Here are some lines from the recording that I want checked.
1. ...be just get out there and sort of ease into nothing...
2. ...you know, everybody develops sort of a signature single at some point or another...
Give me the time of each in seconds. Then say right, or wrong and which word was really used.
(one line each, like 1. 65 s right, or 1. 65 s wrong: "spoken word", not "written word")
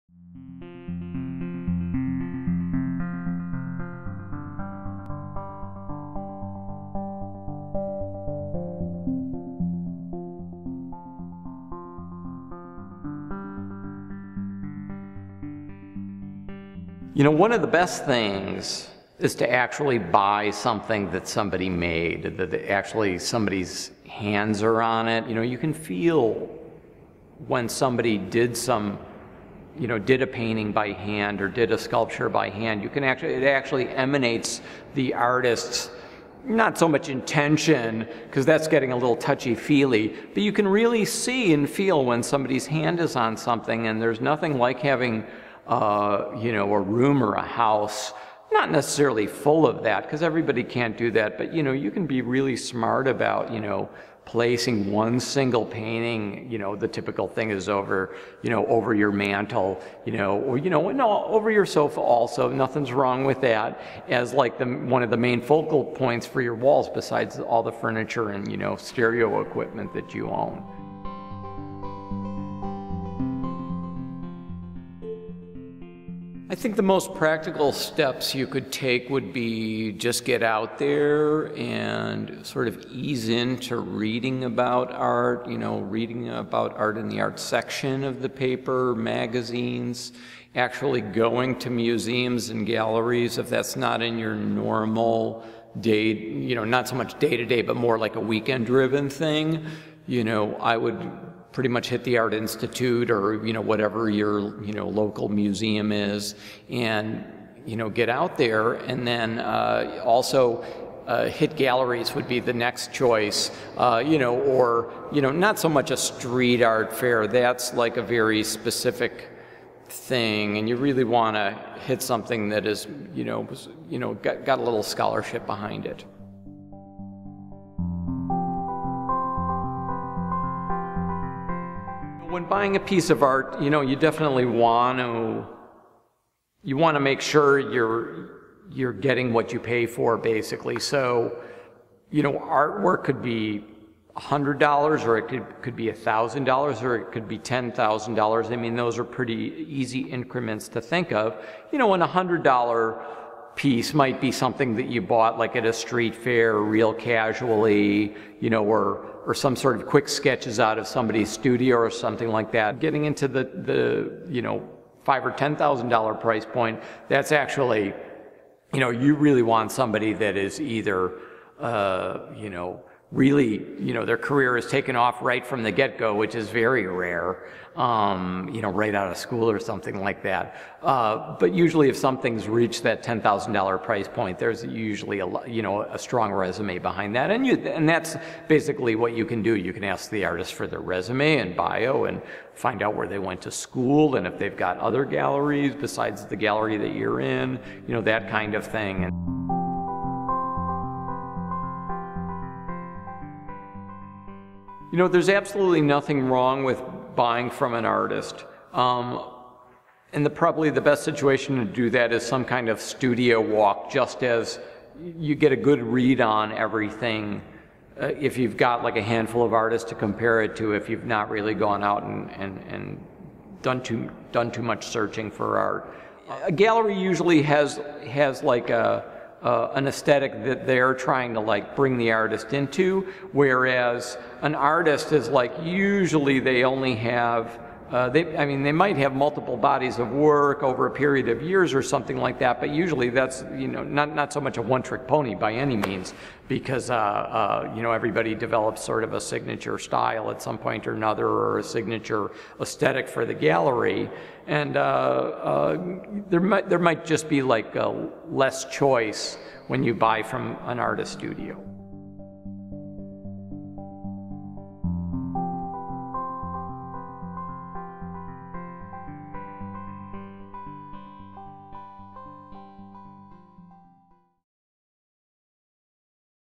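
1. 79 s wrong: "reading", not "nothing"
2. 247 s wrong: "style", not "single".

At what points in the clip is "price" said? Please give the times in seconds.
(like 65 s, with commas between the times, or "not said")
166 s, 183 s.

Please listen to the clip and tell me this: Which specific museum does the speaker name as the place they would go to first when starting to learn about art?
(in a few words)
Art Institute.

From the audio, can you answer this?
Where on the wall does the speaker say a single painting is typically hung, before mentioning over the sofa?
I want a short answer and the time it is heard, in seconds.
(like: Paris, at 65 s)
over your mantle, at 58 s.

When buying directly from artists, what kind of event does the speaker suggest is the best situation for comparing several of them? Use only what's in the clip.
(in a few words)
studio walk.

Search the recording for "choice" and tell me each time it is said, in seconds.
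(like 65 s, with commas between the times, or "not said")
112 s, 258 s.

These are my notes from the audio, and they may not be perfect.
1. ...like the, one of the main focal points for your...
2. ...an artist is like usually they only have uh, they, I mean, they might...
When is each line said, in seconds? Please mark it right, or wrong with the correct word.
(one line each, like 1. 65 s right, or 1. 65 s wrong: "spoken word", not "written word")
1. 64 s right
2. 234 s right.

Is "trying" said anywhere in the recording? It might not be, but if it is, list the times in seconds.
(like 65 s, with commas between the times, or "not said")
230 s.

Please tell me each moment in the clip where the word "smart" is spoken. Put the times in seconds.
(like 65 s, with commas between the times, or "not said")
52 s.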